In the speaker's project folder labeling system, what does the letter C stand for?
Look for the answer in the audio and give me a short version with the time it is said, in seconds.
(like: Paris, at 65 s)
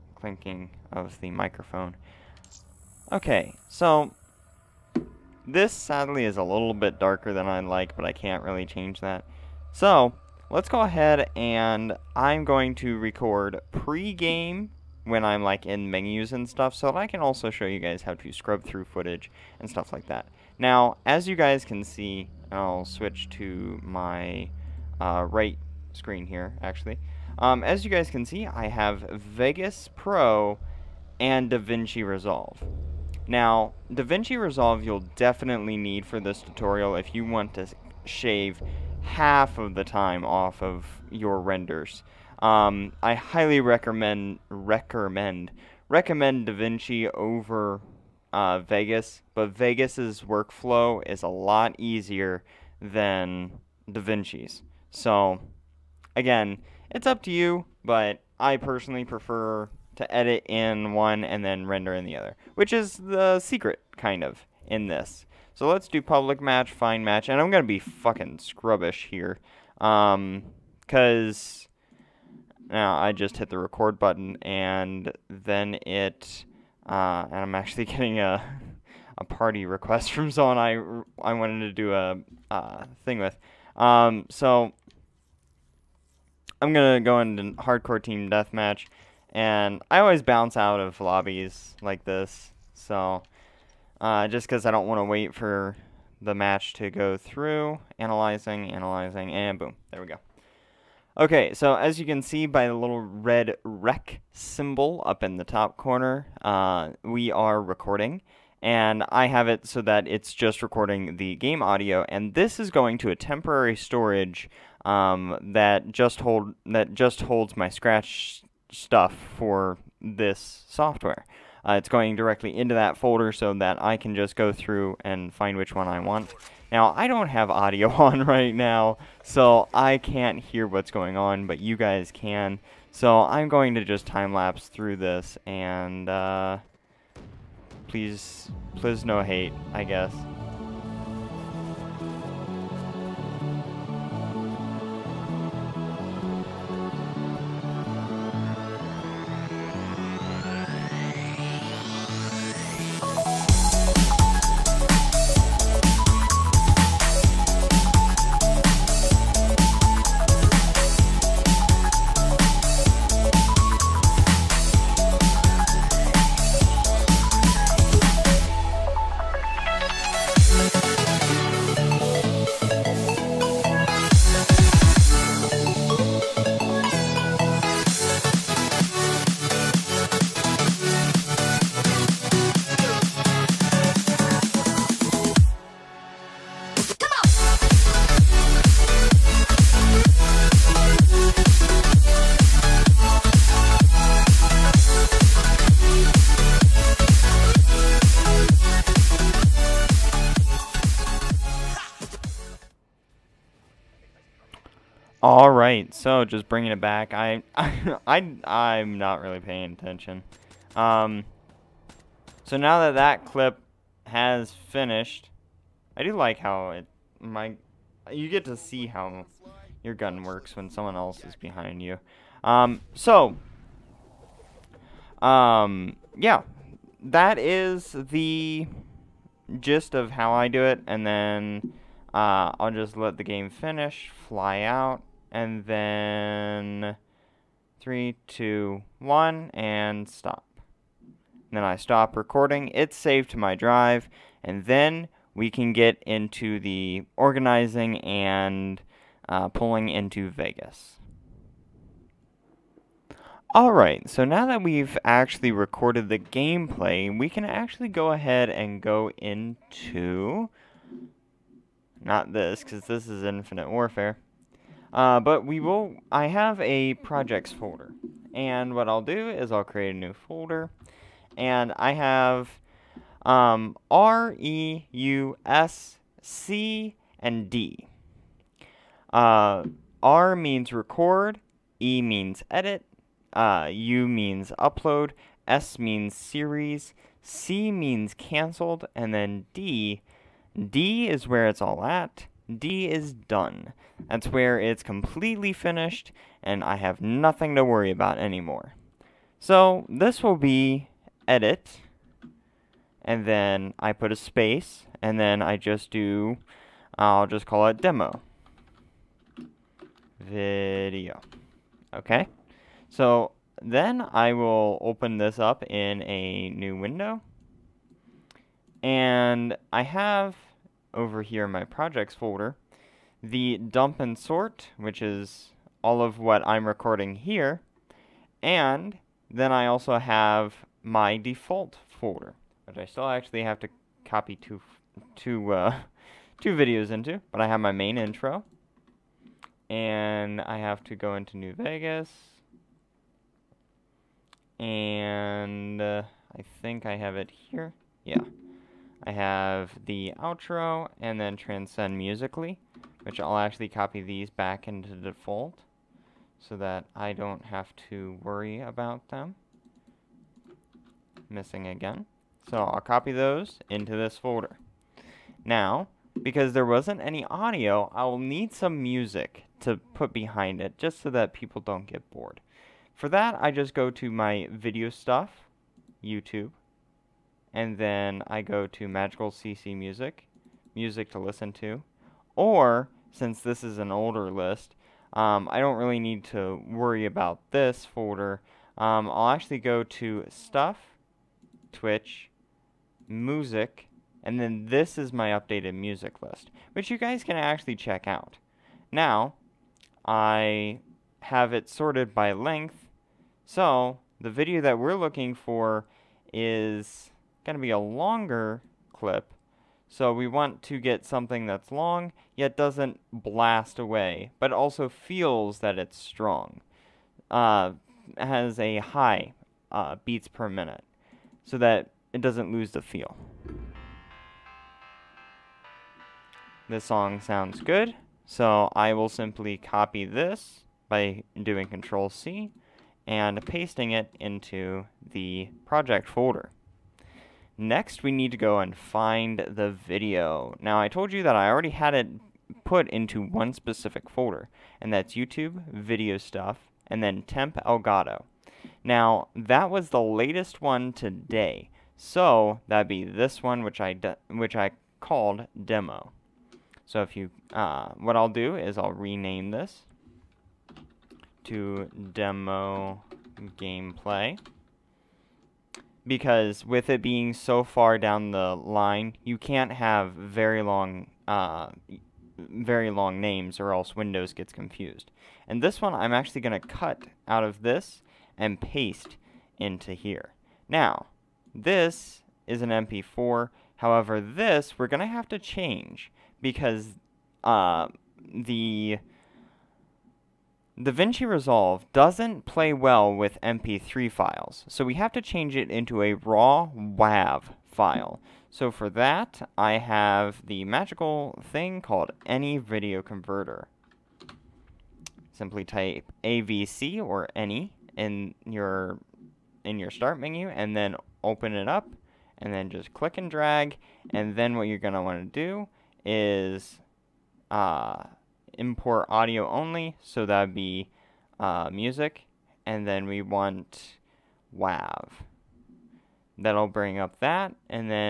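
Canceled, at 288 s.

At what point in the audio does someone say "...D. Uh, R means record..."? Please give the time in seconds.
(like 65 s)
277 s.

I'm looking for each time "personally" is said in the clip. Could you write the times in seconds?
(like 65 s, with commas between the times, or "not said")
58 s.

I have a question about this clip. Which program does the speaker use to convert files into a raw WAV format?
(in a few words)
Any Video Converter.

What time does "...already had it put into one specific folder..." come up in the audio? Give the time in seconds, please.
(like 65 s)
441 s.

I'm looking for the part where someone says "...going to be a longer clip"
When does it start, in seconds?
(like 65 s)
407 s.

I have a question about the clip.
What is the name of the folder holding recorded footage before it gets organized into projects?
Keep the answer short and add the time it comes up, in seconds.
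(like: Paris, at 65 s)
Dump and sort, at 323 s.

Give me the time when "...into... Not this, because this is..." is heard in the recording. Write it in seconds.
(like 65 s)
259 s.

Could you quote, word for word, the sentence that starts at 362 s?
So I'll copy those into this folder.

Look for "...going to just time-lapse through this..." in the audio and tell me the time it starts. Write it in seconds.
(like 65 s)
133 s.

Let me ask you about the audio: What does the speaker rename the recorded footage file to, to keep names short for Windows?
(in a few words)
Demo gameplay.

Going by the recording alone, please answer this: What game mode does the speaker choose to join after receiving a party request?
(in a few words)
Hardcore team deathmatch.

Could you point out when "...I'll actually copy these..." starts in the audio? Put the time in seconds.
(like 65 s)
353 s.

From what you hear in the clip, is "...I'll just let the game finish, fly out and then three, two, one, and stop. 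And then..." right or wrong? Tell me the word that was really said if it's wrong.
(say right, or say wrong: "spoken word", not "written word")
right.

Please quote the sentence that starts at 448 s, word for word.
Now, that was the latest one today, so that'd be this one, which I, which I called demo.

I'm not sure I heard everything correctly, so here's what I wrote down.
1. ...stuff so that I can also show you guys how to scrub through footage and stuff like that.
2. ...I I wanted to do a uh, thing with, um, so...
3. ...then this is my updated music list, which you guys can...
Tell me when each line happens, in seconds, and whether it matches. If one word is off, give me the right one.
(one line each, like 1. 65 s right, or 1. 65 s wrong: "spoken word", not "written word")
1. 16 s right
2. 80 s right
3. 394 s right.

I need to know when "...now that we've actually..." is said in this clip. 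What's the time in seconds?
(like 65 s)
254 s.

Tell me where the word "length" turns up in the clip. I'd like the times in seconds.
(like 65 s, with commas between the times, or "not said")
402 s.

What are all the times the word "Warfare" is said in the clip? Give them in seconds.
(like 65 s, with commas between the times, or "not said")
263 s.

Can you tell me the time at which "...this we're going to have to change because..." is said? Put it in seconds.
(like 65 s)
484 s.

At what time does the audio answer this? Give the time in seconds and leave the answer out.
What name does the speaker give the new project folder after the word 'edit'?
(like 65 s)
307 s.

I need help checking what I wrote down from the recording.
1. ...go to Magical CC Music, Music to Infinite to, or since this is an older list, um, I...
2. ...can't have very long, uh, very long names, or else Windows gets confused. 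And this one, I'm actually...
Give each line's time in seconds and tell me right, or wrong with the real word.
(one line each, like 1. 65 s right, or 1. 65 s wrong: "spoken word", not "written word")
1. 378 s wrong: "Listen", not "Infinite"
2. 469 s right.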